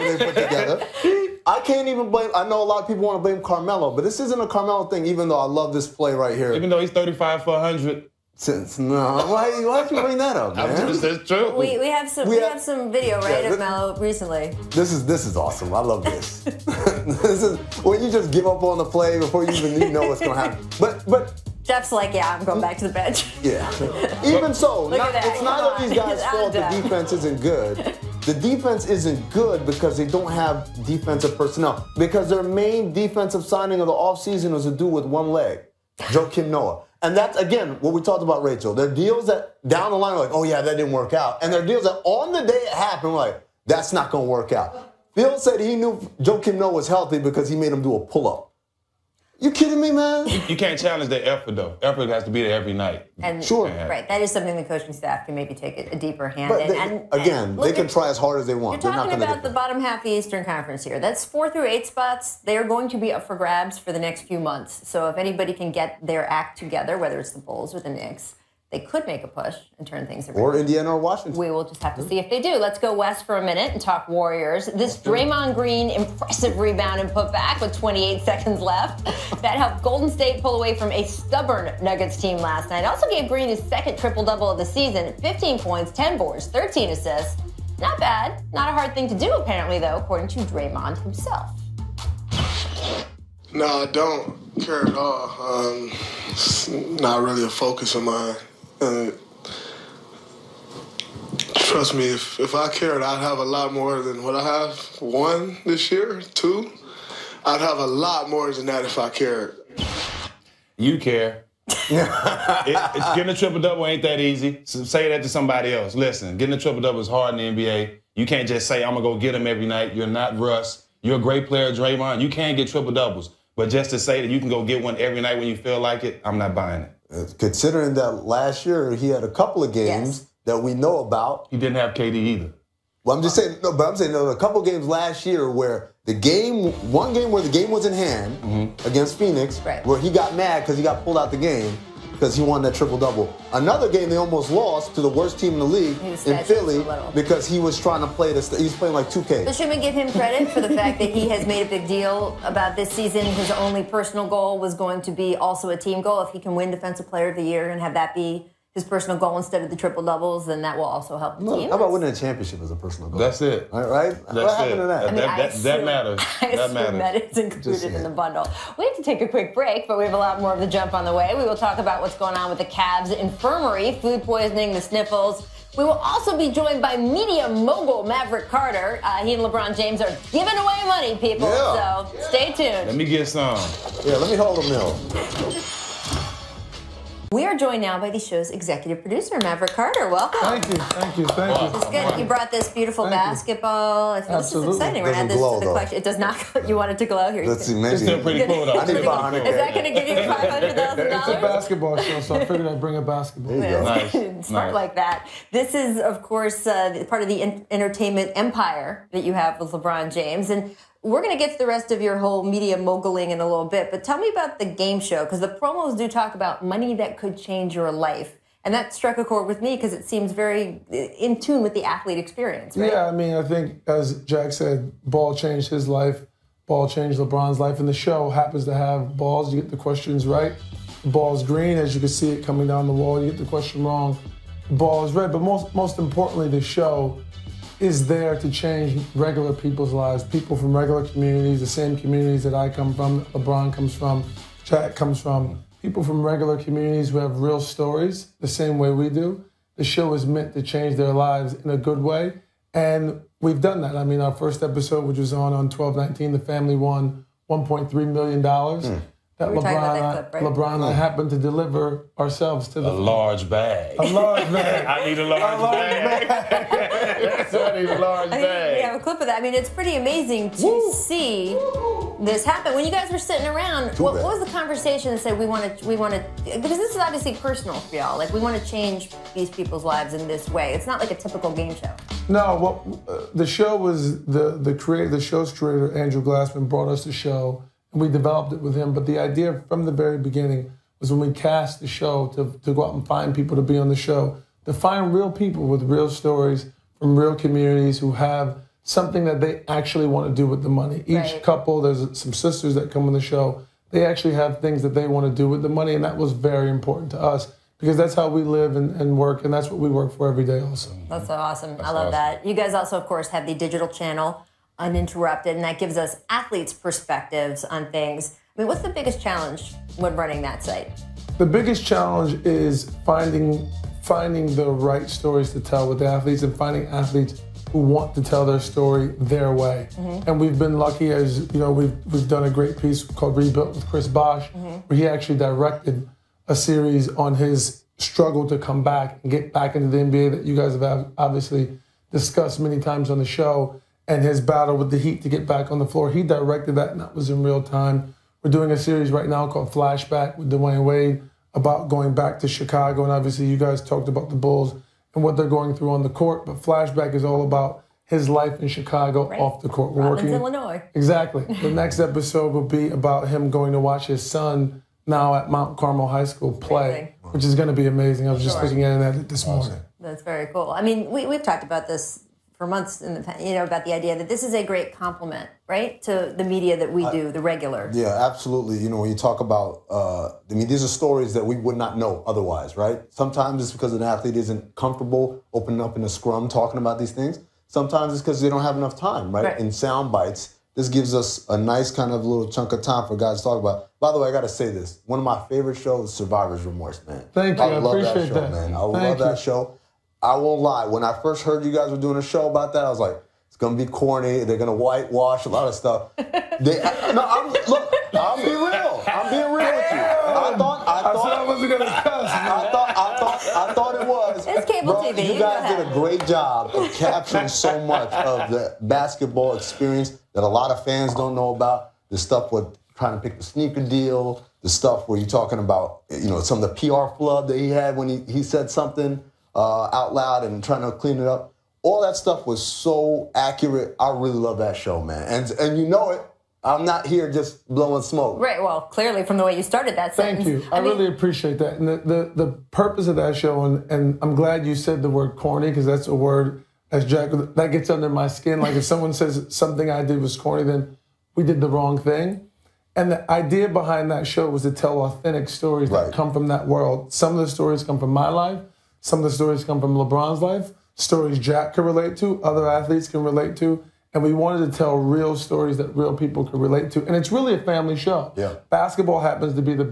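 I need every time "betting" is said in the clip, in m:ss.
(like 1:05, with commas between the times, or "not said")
not said.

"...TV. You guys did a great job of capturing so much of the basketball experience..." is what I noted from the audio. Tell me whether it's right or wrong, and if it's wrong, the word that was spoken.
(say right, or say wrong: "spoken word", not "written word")
right.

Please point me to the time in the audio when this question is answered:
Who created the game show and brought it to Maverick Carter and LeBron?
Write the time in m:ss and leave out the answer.
4:45.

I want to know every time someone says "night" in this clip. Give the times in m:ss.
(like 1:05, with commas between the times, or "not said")
0:52, 1:22, 1:59, 2:05.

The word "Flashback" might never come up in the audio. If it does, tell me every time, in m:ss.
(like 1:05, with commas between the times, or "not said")
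5:49, 5:56.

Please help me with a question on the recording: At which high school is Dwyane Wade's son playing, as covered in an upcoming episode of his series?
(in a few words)
Mount Carmel High School.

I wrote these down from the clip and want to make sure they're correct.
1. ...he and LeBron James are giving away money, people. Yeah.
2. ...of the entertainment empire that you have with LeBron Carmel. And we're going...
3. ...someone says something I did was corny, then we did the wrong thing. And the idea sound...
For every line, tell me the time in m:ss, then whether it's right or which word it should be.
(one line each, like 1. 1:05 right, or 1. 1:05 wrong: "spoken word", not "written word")
1. 2:59 right
2. 3:27 wrong: "James", not "Carmel"
3. 7:28 wrong: "behind", not "sound".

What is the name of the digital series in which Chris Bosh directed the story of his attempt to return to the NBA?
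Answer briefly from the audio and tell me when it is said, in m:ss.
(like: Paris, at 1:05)
Rebuilt, at 5:33.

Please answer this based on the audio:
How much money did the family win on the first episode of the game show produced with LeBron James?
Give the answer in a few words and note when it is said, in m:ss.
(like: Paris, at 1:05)
$1.3 million, at 4:17.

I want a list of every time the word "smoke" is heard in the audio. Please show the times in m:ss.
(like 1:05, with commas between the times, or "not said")
7:18.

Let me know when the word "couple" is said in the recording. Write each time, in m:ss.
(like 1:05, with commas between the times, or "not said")
2:09, 2:14, 5:01.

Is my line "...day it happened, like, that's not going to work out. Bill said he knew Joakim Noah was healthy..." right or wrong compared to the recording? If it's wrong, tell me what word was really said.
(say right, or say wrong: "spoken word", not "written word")
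right.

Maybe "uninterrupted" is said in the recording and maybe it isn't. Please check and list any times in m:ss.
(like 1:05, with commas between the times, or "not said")
5:14.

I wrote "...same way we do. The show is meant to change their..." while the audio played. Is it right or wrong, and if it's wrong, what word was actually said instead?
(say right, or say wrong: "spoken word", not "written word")
right.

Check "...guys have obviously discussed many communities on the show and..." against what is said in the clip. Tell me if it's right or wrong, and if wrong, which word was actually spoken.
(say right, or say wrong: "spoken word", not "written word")
wrong: "times", not "communities".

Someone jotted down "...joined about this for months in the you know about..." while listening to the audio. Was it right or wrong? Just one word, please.
wrong.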